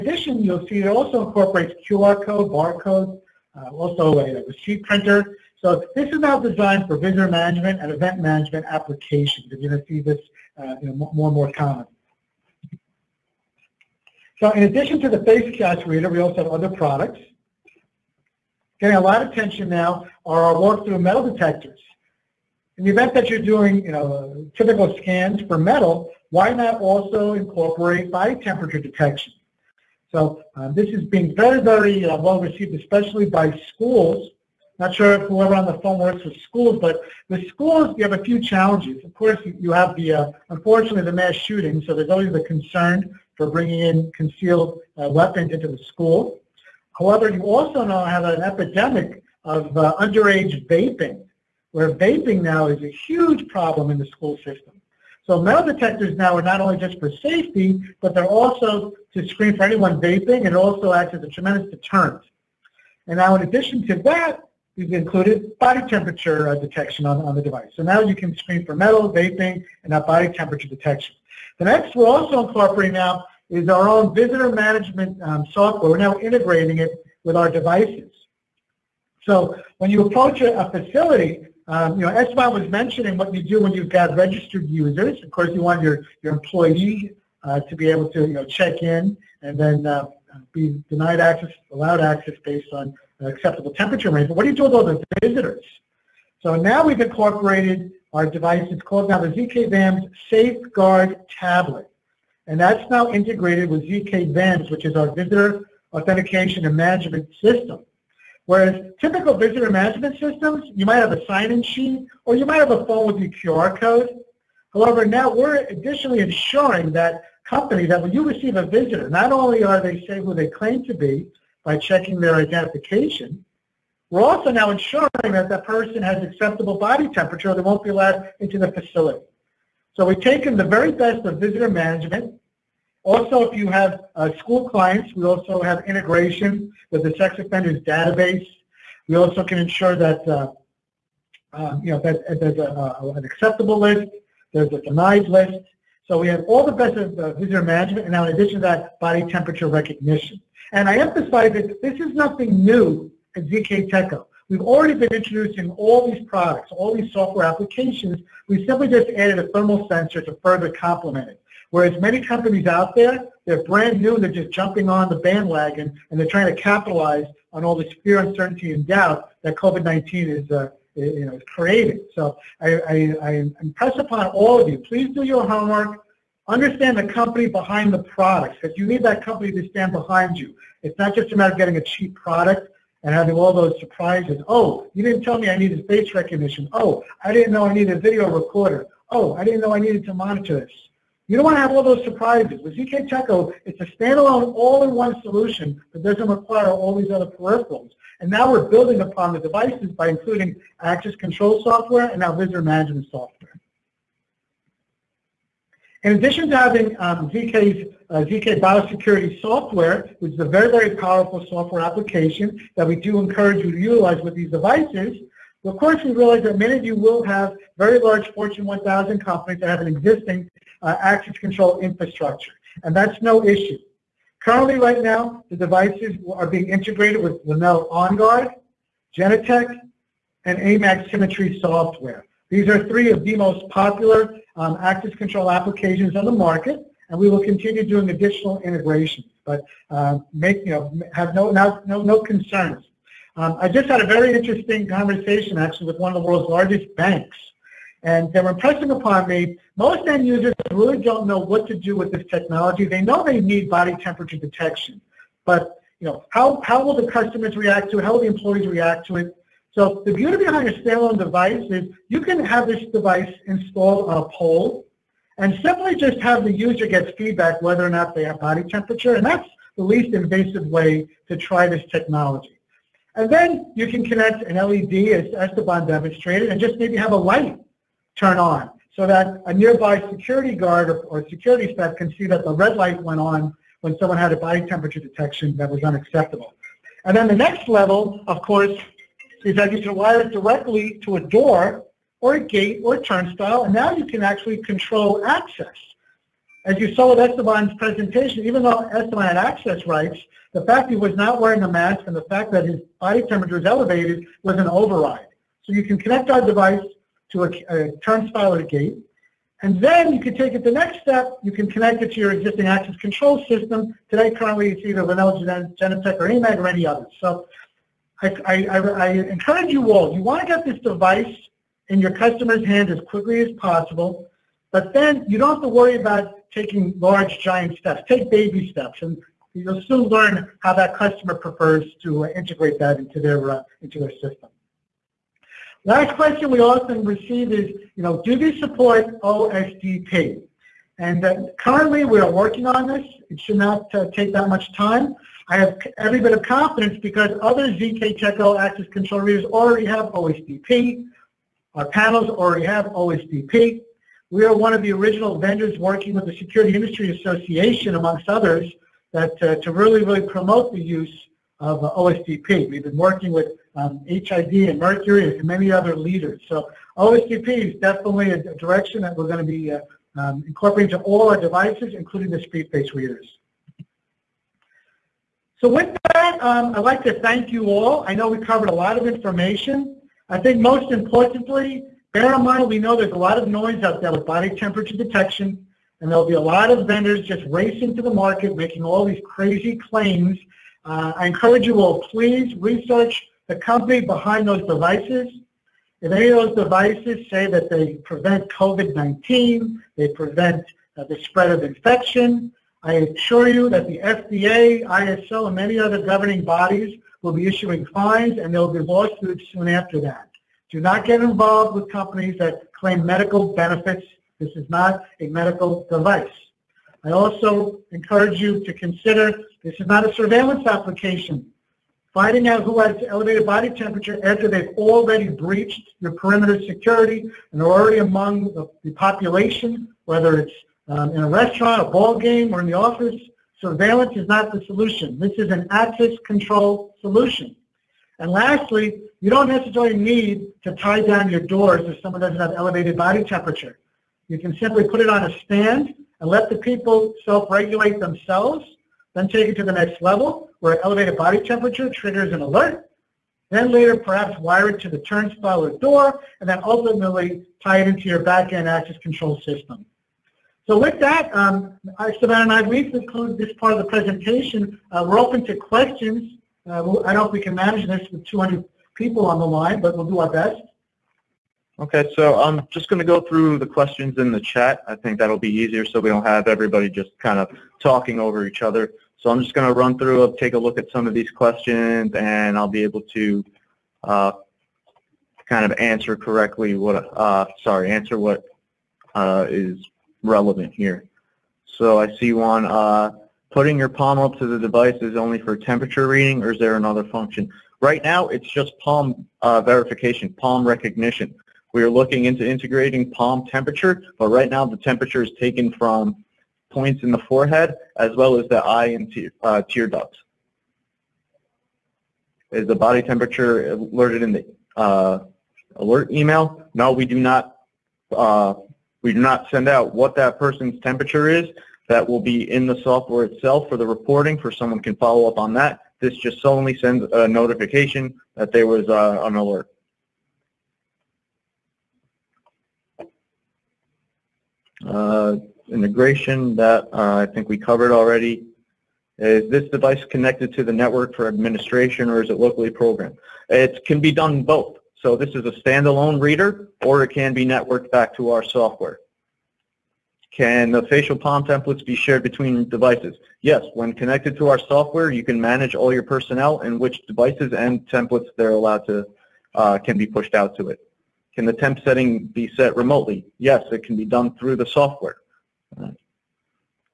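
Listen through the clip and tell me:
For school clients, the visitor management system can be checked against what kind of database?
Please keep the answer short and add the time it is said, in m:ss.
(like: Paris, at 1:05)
sex offenders database, at 2:17.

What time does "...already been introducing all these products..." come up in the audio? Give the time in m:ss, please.
2:34.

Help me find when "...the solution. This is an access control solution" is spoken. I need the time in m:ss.
7:14.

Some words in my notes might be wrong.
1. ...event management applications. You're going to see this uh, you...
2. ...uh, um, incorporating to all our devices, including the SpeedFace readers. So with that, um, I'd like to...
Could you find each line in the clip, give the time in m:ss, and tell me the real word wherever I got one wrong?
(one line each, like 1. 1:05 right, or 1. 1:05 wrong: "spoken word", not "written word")
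1. 0:07 right
2. 6:09 right.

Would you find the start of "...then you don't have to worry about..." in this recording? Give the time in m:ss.
5:24.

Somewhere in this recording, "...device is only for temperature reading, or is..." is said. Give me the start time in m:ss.
8:14.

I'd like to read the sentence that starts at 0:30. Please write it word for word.
So um, this is being very, very uh, well received, especially by schools.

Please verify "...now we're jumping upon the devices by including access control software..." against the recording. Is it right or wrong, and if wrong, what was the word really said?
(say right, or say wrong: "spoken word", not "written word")
wrong: "building", not "jumping".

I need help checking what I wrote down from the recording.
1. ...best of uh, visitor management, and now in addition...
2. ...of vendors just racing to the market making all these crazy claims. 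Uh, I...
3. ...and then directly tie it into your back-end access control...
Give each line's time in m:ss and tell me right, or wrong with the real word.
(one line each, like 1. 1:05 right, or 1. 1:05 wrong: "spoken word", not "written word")
1. 2:26 right
2. 6:26 right
3. 7:36 wrong: "ultimately", not "directly".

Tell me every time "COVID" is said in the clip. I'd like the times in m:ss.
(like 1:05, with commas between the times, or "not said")
2:49, 6:38.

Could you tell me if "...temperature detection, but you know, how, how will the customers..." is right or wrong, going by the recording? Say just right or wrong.
right.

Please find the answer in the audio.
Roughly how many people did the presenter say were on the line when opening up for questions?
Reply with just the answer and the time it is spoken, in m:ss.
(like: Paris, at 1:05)
200, at 7:48.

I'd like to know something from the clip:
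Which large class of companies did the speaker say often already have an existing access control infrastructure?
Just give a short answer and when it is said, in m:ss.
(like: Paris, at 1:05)
Fortune 1000, at 3:38.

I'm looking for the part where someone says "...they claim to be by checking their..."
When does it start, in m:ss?
2:00.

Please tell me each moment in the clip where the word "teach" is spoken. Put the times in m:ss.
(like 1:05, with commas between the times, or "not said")
not said.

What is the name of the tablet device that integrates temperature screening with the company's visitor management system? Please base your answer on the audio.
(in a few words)
ZK VAMS Safeguard Tablet.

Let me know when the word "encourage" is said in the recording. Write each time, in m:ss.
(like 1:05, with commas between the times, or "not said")
3:33, 5:19, 6:31, 6:57.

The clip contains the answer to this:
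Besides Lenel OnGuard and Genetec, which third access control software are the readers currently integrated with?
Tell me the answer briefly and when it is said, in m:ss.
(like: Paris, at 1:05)
AMAG Symmetry, at 3:50.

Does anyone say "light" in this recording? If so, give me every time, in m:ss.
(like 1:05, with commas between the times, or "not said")
4:37, 4:42.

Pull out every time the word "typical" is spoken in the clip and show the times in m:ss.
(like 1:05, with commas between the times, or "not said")
0:24, 1:49.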